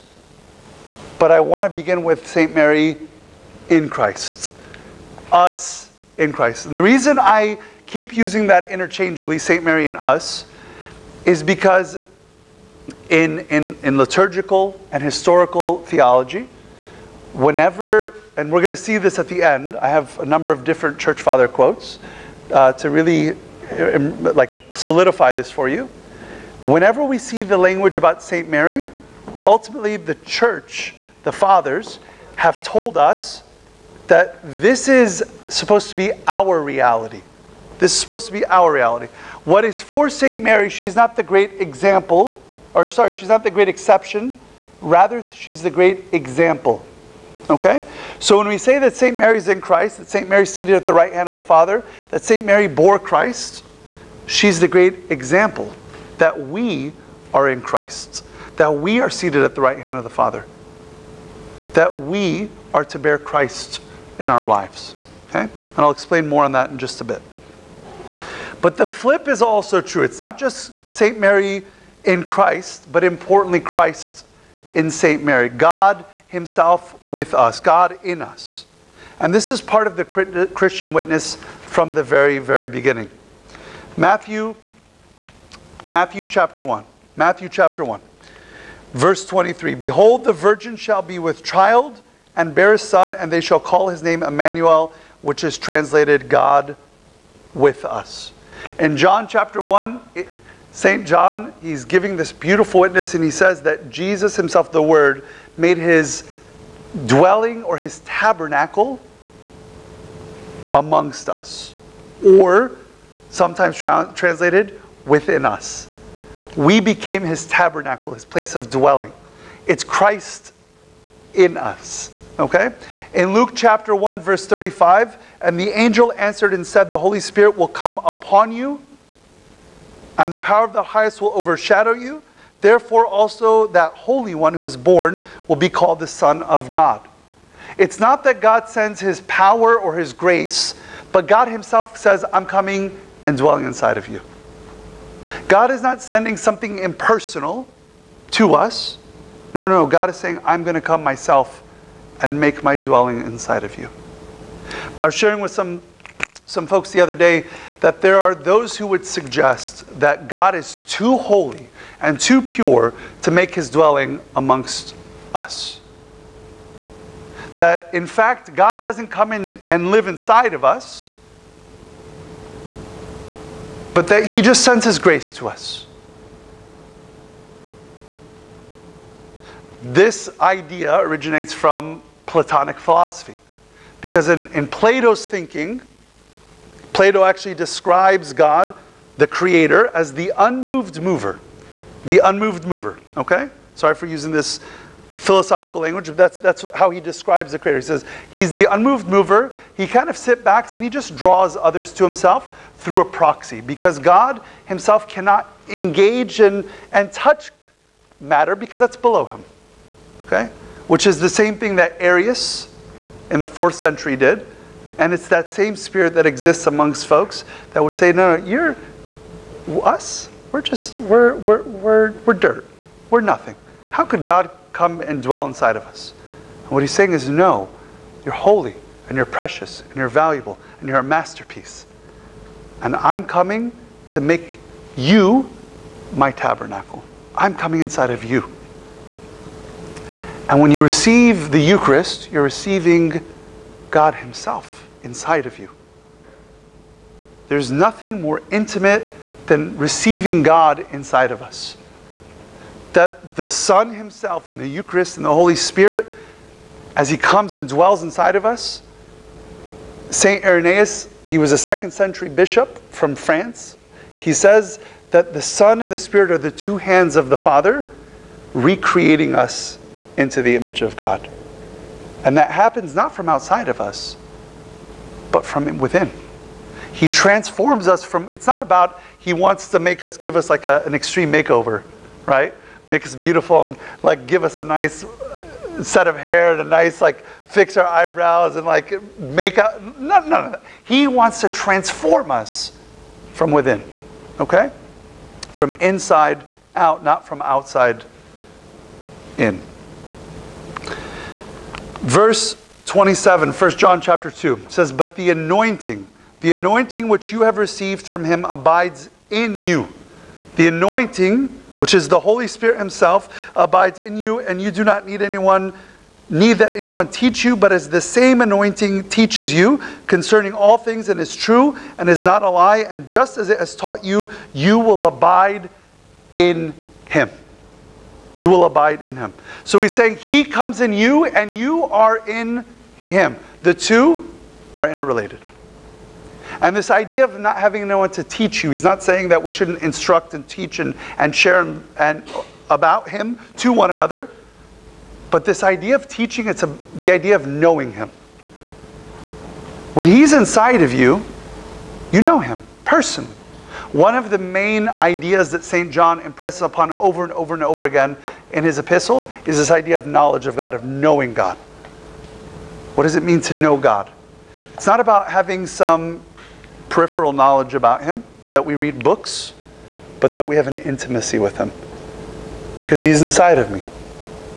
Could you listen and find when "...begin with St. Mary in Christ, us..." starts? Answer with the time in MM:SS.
00:01.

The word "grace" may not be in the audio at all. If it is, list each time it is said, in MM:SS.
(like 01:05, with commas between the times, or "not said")
02:20, 02:54.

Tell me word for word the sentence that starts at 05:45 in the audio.
But this idea of teaching, it's a, the idea of knowing him.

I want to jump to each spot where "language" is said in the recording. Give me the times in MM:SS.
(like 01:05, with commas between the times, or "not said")
00:27, 03:15.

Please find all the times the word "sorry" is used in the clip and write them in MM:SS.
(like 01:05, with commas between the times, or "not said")
00:42, 03:13.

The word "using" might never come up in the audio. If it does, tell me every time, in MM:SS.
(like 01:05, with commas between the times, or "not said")
00:08, 03:14.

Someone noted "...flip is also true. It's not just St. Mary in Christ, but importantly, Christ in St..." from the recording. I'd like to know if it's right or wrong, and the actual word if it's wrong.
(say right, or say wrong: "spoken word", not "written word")
right.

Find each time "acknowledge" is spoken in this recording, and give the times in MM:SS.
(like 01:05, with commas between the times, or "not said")
not said.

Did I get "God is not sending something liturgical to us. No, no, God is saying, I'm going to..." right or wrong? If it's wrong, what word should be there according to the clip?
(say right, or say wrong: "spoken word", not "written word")
wrong: "impersonal", not "liturgical".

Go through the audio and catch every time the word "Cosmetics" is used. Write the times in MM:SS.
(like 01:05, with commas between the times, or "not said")
not said.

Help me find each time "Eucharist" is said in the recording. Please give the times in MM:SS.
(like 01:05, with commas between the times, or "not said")
04:01, 04:14.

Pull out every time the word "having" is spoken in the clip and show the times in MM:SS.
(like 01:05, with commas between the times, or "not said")
05:37, 06:05.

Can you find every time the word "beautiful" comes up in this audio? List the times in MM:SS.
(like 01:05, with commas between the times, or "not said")
01:42, 04:43.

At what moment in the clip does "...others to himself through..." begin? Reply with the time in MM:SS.
03:21.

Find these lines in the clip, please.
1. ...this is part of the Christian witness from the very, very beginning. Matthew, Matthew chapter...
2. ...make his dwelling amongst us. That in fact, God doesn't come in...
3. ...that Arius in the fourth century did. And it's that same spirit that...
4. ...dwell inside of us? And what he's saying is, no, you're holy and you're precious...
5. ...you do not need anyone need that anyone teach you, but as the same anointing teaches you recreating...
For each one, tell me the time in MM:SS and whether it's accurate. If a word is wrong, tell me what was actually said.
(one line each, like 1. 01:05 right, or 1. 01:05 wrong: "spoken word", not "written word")
1. 01:19 right
2. 02:43 right
3. 03:31 right
4. 03:45 right
5. 05:14 wrong: "concerning", not "recreating".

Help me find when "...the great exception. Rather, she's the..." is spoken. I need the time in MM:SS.
00:43.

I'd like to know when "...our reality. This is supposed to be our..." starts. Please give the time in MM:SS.
00:36.